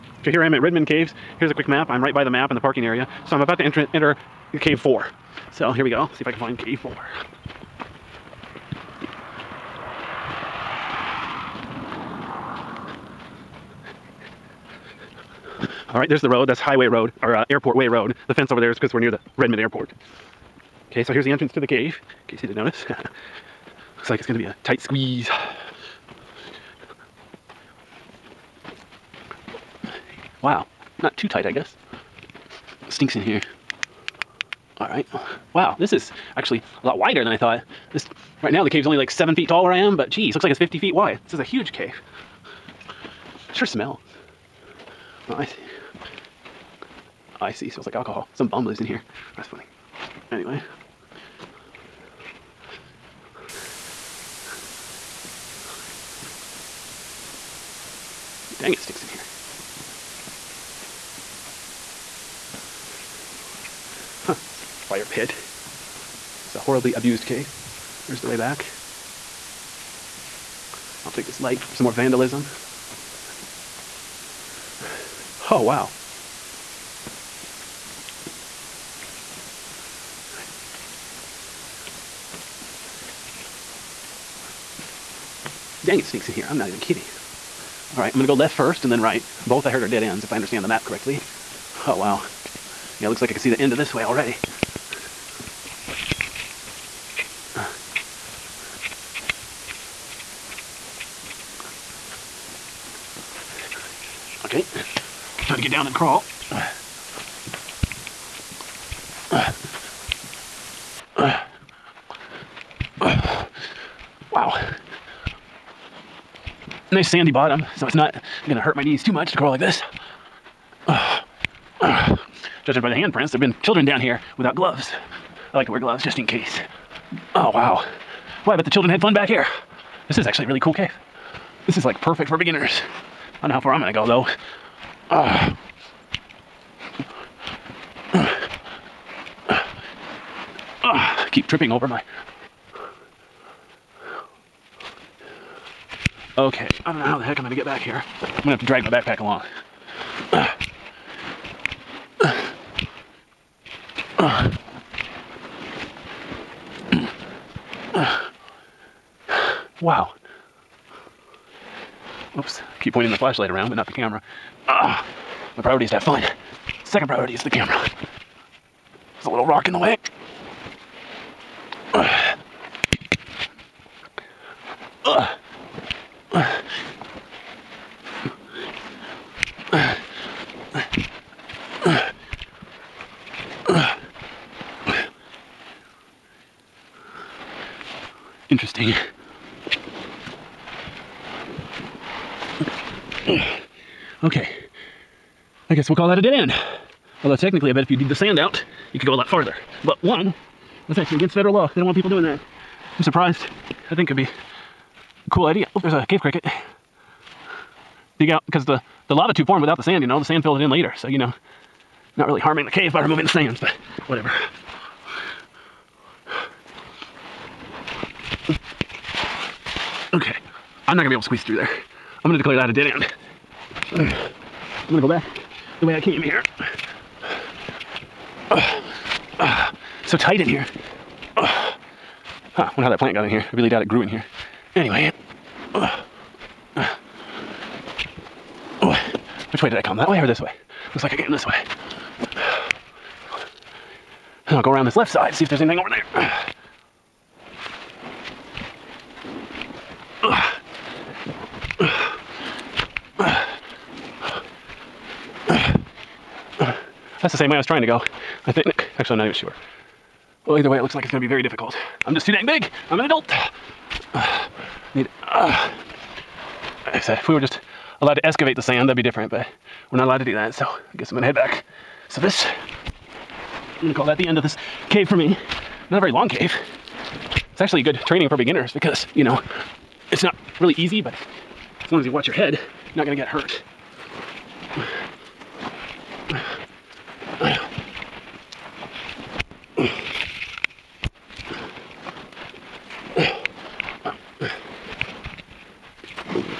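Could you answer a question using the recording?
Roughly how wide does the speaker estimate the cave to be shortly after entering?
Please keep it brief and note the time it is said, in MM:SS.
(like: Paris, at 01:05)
50 feet, at 00:40.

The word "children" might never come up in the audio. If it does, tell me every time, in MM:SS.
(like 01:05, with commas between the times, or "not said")
02:03, 02:08.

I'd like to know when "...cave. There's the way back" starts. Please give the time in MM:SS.
01:07.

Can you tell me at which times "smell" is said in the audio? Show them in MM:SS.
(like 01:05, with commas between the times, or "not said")
00:43, 00:47.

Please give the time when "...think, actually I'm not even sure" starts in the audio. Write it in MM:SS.
04:18.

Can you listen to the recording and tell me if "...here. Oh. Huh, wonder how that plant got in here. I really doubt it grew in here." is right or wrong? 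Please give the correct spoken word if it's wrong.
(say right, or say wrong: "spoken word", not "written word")
right.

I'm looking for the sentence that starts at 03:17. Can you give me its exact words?
Although technically, I bet if you dig the sand out, you could go a lot farther.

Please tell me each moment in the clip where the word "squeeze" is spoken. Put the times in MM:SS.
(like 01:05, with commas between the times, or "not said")
00:24, 03:41.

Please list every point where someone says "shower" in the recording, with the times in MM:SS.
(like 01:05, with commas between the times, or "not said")
not said.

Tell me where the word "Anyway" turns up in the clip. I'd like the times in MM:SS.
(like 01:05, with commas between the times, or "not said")
00:50, 03:54.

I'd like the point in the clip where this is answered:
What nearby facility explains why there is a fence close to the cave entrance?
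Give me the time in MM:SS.
00:19.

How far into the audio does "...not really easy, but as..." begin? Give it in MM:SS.
04:40.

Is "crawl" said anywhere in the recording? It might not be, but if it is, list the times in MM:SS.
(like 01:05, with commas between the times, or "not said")
01:45, 01:59.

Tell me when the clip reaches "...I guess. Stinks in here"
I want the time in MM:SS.
00:31.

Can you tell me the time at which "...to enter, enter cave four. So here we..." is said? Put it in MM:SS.
00:03.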